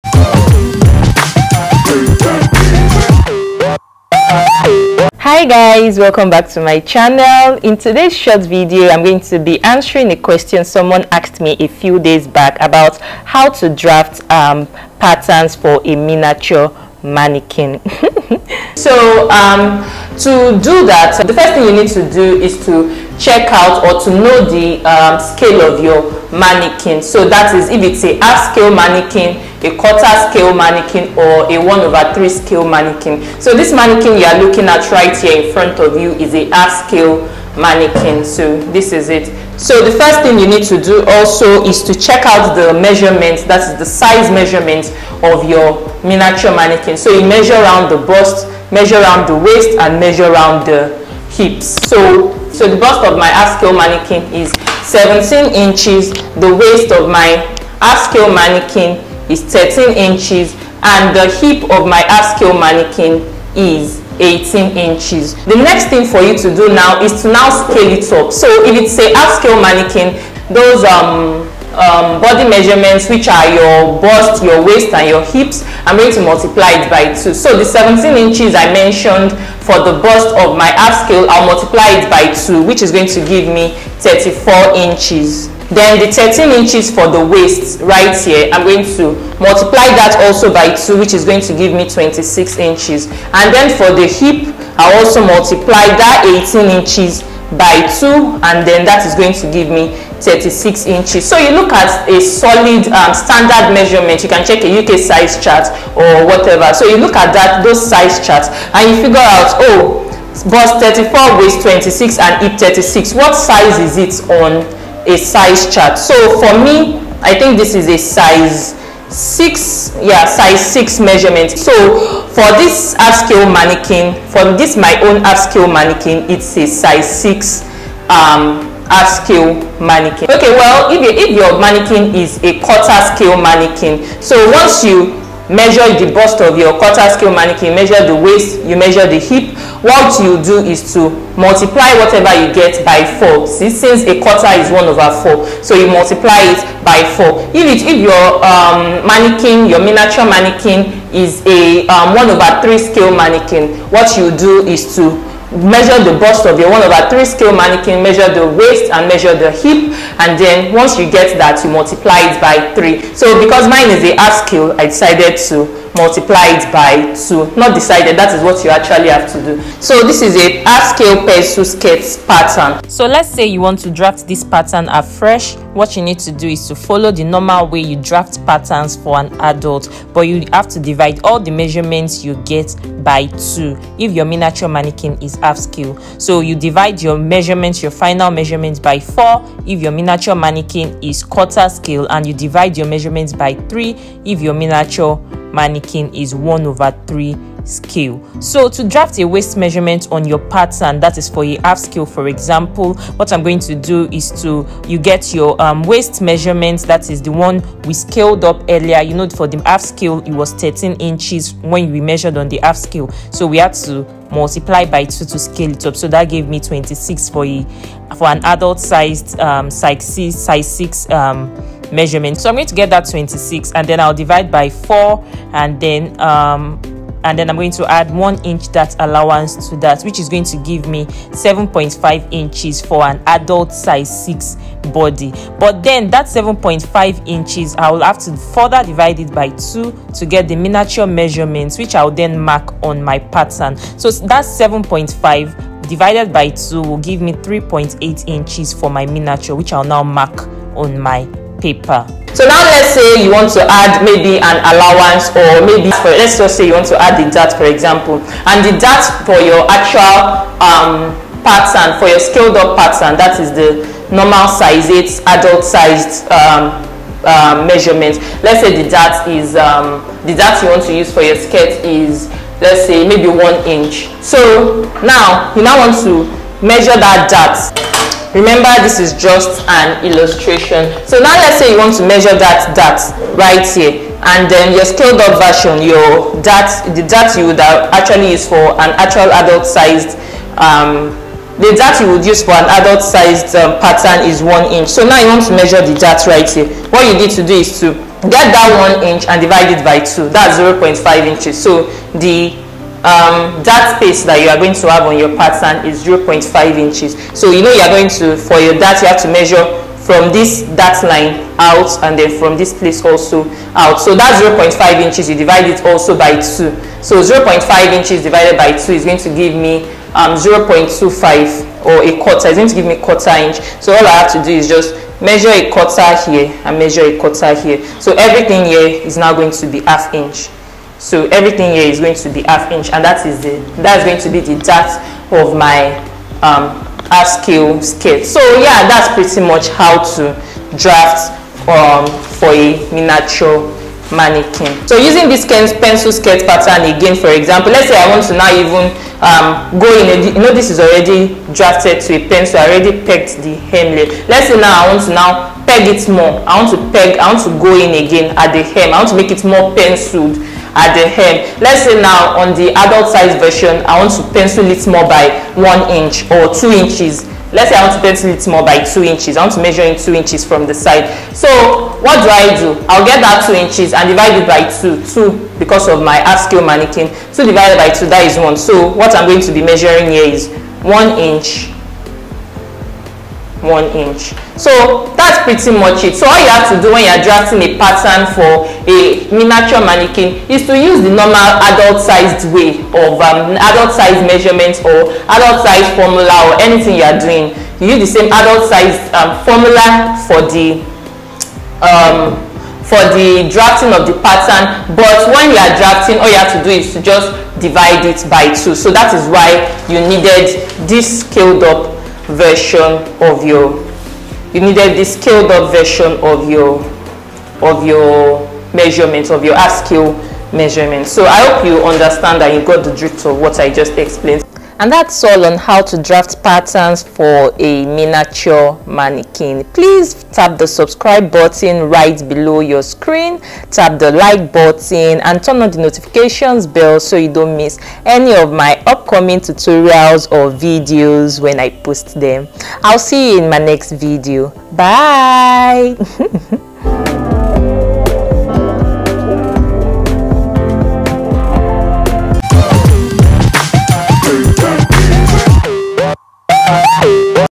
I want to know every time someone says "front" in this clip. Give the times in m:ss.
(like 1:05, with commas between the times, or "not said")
0:35.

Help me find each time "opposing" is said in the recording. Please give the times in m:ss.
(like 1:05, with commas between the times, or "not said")
not said.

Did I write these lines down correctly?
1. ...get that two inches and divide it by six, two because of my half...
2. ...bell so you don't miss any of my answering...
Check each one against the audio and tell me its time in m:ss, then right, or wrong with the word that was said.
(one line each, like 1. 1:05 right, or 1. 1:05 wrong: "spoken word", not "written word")
1. 6:13 wrong: "two", not "six"
2. 7:16 wrong: "upcoming", not "answering".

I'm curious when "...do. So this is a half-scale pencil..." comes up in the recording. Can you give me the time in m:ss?
2:49.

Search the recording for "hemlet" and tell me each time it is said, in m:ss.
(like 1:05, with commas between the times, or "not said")
5:53.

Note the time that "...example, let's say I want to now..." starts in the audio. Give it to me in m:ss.
5:47.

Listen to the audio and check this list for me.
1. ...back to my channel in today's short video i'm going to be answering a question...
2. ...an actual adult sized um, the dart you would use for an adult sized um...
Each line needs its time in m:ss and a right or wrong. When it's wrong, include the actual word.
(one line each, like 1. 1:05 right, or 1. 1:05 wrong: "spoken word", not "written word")
1. 0:06 right
2. 4:48 right.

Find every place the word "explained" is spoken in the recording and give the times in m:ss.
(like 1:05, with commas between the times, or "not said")
7:03.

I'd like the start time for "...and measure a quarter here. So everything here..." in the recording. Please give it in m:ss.
5:26.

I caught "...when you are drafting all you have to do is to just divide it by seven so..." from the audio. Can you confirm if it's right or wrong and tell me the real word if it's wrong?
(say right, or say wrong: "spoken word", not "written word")
wrong: "two", not "seven".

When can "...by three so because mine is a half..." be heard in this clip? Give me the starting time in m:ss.
2:42.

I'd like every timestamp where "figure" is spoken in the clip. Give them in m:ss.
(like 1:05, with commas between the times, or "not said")
1:49.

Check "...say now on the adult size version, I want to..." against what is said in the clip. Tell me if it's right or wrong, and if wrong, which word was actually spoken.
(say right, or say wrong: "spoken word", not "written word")
right.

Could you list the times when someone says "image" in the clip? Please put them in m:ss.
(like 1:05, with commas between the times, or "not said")
not said.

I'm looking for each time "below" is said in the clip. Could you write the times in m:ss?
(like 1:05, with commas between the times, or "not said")
7:12.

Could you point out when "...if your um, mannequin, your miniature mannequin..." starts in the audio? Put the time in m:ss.
2:27.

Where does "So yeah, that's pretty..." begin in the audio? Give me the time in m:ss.
5:38.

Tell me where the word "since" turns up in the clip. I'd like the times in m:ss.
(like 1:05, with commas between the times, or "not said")
2:23.